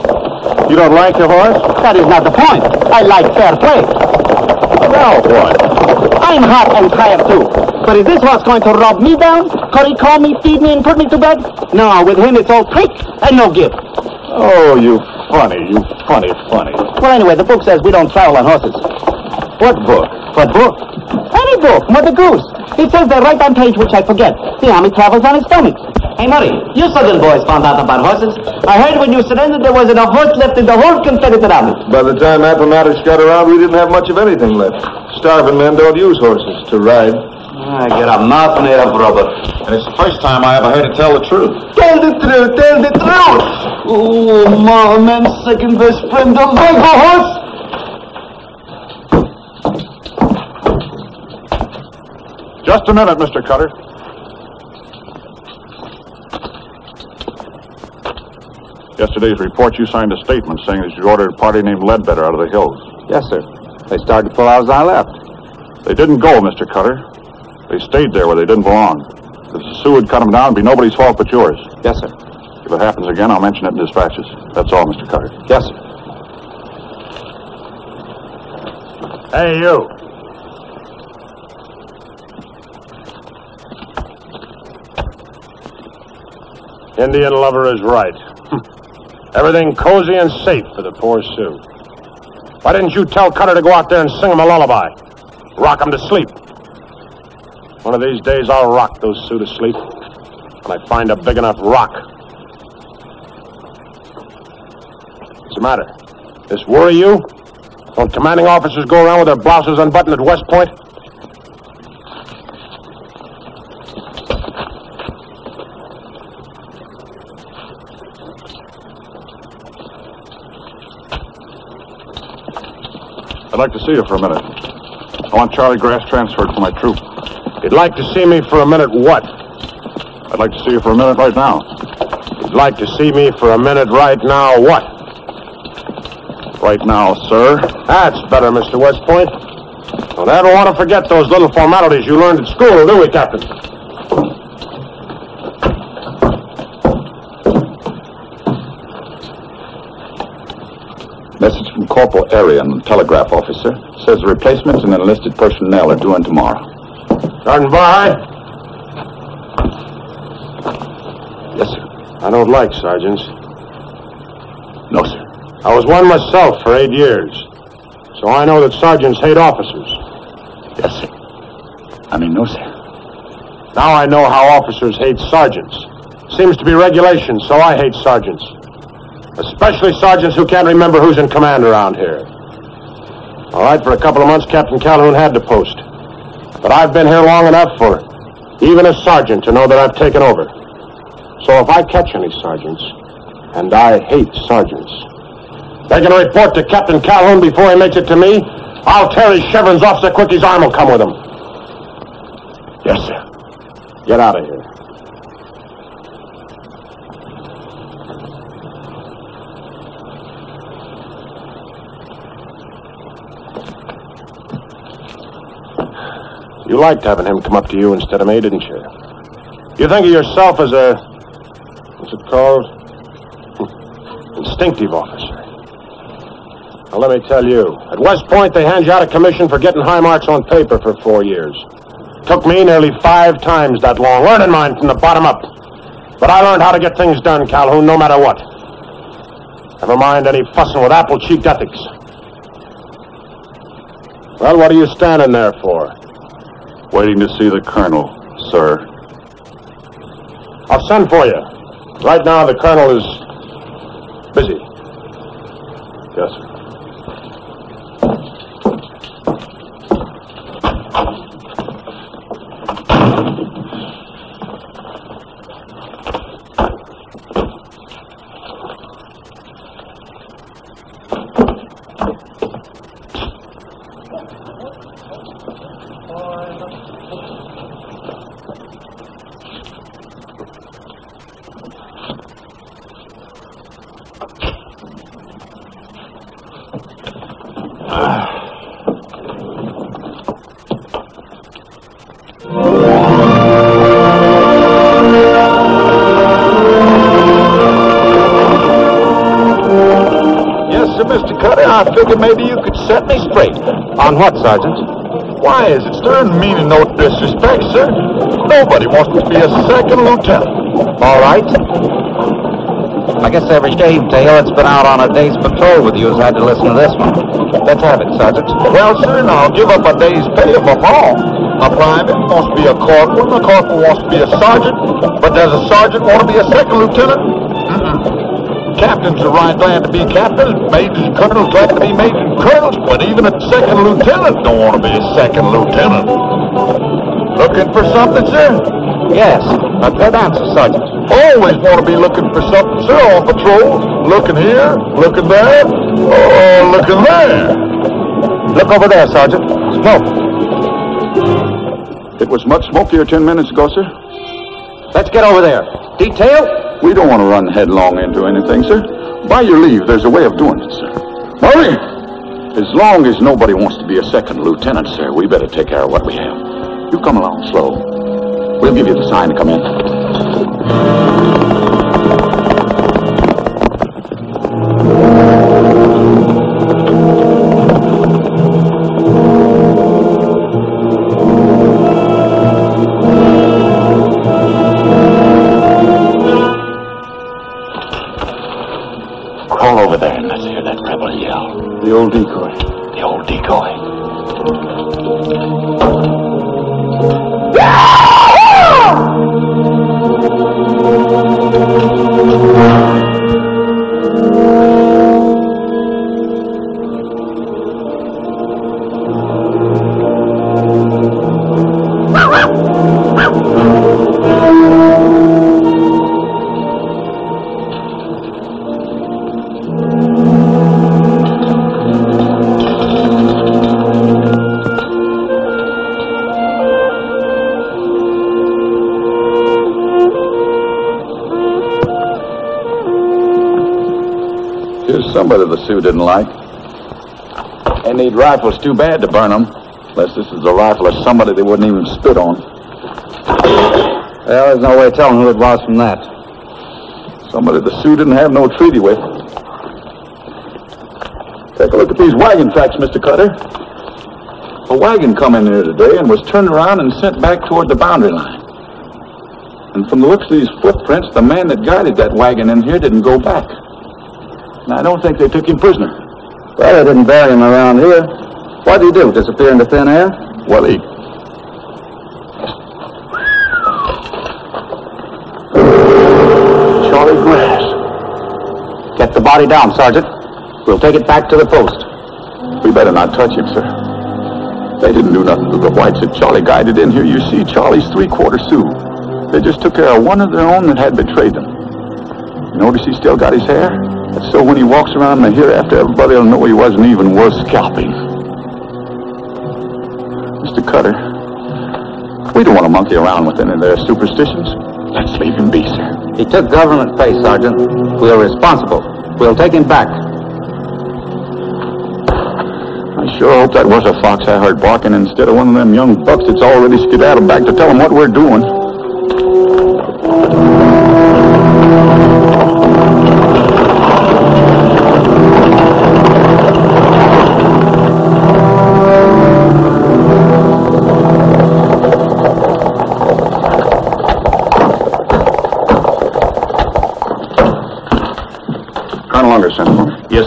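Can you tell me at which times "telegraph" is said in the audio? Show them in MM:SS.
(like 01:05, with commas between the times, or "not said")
02:32.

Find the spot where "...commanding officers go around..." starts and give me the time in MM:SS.
01:48.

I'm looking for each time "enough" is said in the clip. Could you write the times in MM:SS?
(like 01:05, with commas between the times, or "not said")
01:41, 03:07.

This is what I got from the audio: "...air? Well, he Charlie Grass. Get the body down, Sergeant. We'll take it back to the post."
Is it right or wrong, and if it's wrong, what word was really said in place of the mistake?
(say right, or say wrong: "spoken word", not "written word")
right.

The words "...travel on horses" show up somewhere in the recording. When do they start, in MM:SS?
00:18.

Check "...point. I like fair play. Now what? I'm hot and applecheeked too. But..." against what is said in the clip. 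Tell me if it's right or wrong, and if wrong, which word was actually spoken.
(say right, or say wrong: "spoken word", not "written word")
wrong: "tired", not "applecheeked".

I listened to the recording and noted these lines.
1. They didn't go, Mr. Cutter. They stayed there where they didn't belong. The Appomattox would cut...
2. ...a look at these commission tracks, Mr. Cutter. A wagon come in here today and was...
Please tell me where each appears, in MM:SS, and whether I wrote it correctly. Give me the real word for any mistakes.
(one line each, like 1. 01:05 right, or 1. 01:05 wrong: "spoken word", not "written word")
1. 01:05 wrong: "Sioux", not "Appomattox"
2. 07:31 wrong: "wagon", not "commission".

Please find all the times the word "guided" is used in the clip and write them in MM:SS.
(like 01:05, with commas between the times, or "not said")
07:41, 08:06.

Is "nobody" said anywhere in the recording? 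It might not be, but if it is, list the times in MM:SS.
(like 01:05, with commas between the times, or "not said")
01:10, 05:08, 06:03, 07:15.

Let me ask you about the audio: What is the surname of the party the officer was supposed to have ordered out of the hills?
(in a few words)
Ledbetter.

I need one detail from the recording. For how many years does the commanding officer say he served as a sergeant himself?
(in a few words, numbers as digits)
8.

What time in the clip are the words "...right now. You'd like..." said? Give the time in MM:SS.
02:11.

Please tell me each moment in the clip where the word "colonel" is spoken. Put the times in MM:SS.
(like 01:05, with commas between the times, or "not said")
04:07, 04:12, 05:31.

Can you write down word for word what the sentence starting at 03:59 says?
Never mind any fussing with apple-cheeked ethics.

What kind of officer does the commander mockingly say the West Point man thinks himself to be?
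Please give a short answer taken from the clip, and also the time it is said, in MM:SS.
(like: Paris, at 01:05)
Instinctive officer, at 03:44.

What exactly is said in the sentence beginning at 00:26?
Hey, Murray, you southern boys found out about horses.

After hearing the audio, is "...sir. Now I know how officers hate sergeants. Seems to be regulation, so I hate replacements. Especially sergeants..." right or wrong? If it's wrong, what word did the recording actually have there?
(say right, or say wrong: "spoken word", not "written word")
wrong: "sergeants", not "replacements".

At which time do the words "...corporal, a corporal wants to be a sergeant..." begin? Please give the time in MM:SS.
05:22.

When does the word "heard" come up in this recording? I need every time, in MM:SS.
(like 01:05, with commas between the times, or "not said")
00:28, 00:40, 08:34.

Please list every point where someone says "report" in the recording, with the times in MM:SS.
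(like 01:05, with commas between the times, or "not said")
00:59, 03:16.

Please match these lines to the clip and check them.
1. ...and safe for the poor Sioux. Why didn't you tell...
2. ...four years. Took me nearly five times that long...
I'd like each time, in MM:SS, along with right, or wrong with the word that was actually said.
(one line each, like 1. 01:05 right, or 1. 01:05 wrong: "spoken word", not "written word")
1. 01:30 right
2. 03:51 right.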